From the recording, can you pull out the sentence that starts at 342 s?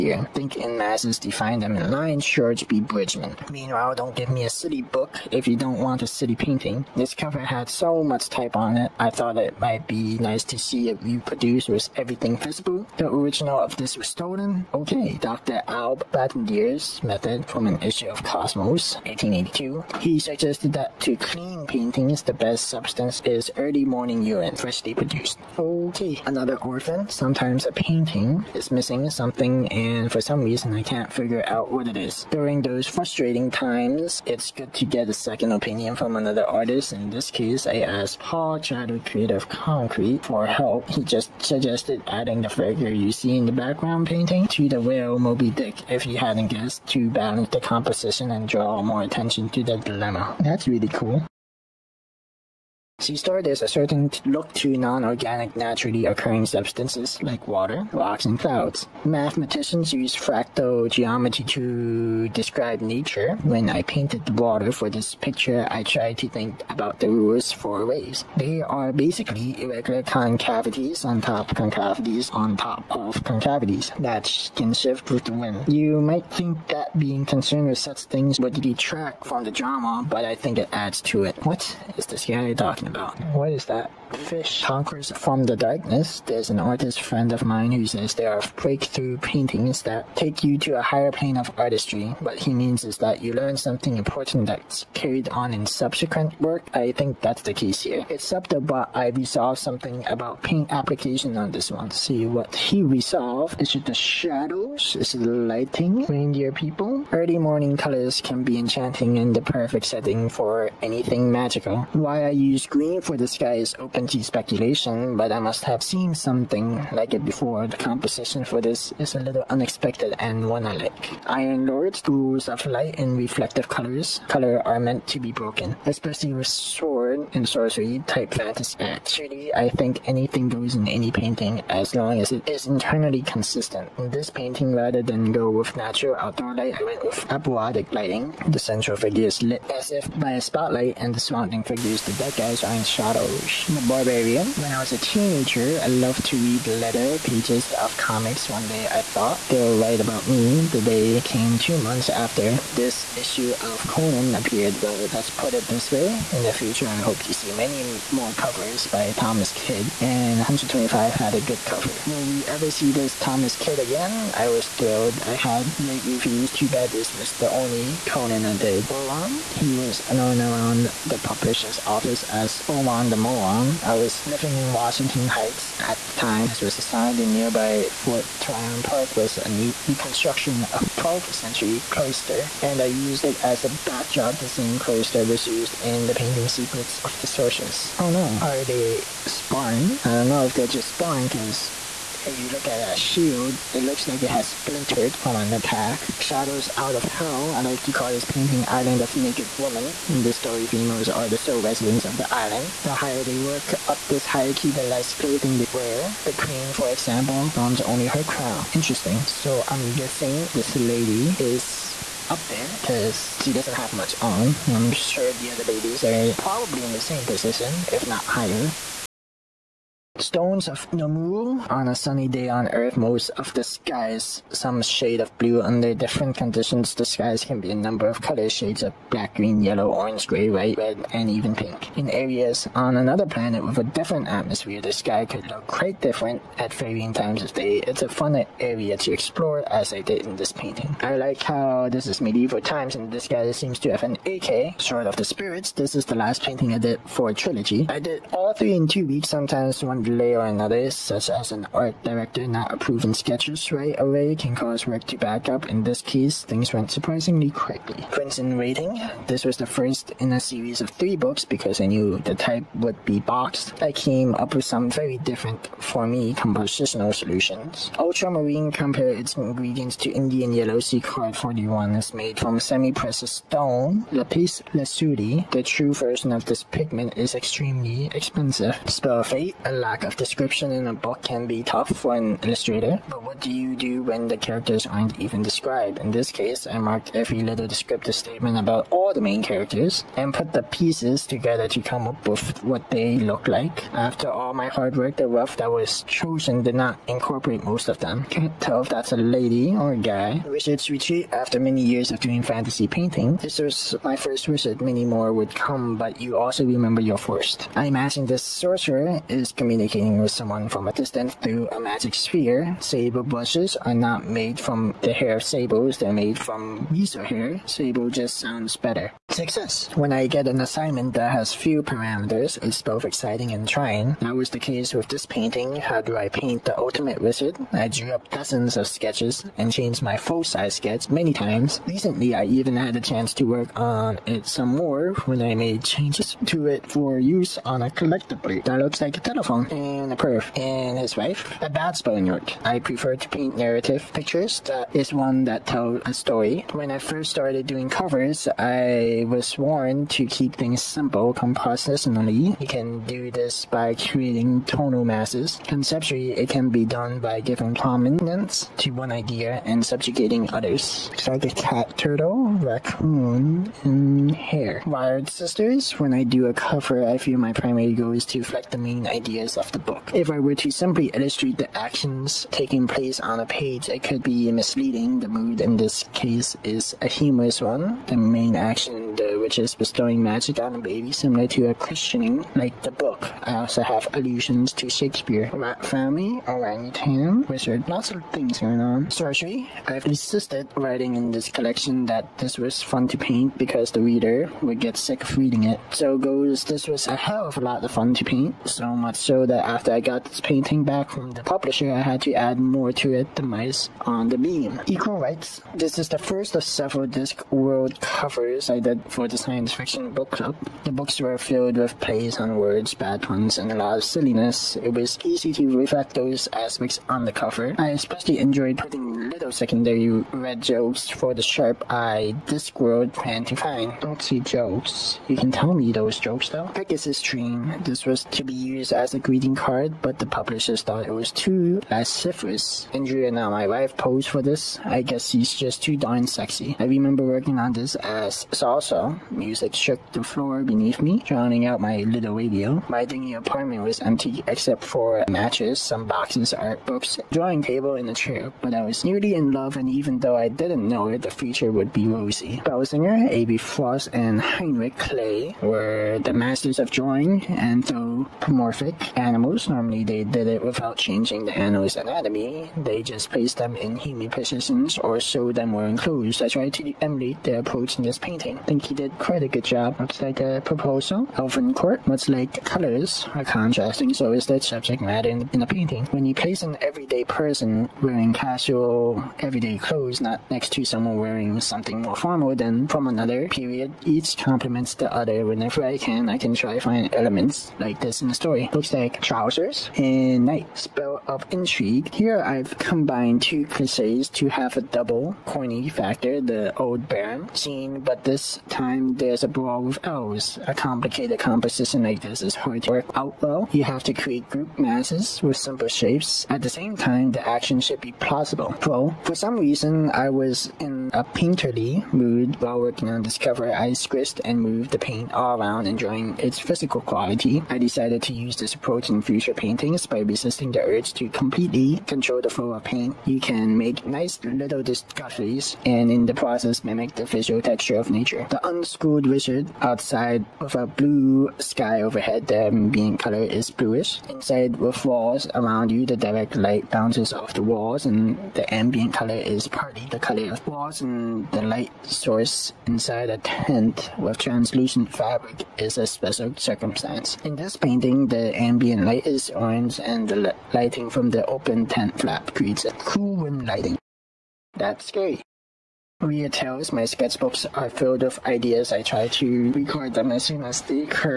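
I prefer to paint narrative pictures that is one that tell a story.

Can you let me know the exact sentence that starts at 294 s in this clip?
After all my hard work, the rough that was chosen did not incorporate most of them.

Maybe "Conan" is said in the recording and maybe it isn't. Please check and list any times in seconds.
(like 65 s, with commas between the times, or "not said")
153 s, 168 s.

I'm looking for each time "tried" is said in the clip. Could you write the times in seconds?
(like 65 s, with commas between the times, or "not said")
65 s, 466 s.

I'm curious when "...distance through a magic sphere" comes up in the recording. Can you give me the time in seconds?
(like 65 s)
310 s.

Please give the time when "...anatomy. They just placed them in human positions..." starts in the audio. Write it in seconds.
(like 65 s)
461 s.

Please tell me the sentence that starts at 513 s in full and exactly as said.
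I squished and moved the paint all around, enjoying its physical quality.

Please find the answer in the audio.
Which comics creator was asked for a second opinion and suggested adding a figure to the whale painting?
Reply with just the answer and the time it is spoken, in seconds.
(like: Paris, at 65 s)
Paul Chadwick, at 38 s.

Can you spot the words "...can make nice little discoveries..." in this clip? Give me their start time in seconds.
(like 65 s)
523 s.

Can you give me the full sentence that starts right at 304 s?
Many more would come, but you also remember your first.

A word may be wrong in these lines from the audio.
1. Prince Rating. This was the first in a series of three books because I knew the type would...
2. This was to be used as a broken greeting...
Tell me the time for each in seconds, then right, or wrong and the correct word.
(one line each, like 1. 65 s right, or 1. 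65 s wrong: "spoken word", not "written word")
1. 258 s right
2. 427 s wrong: "green", not "broken".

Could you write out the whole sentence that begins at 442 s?
My dingy apartment was empty except for matches, some boxes, art books, drawing table, and a chair.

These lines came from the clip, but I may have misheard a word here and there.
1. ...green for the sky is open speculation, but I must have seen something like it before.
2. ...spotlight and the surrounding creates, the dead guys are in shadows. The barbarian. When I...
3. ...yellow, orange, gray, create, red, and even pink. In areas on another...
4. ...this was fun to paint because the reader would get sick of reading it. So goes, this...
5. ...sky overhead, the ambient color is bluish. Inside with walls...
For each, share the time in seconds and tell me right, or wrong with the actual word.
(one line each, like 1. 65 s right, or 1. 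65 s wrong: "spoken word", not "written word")
1. 112 s right
2. 140 s wrong: "figures", not "creates"
3. 229 s wrong: "white", not "create"
4. 392 s right
5. 531 s right.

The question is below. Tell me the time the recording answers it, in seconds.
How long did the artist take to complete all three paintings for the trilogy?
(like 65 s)
248 s.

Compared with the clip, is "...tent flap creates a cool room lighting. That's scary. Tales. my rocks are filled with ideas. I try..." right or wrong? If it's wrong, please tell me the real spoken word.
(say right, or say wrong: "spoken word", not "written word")
wrong: "sketchbooks", not "rocks".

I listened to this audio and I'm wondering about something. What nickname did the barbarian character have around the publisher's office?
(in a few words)
Oman the Moron.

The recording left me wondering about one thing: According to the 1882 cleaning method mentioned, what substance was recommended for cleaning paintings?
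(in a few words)
Early morning urine.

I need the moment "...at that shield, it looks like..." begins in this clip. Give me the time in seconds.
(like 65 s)
192 s.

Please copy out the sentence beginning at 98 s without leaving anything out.
Except that I resolved something about paint application on this one.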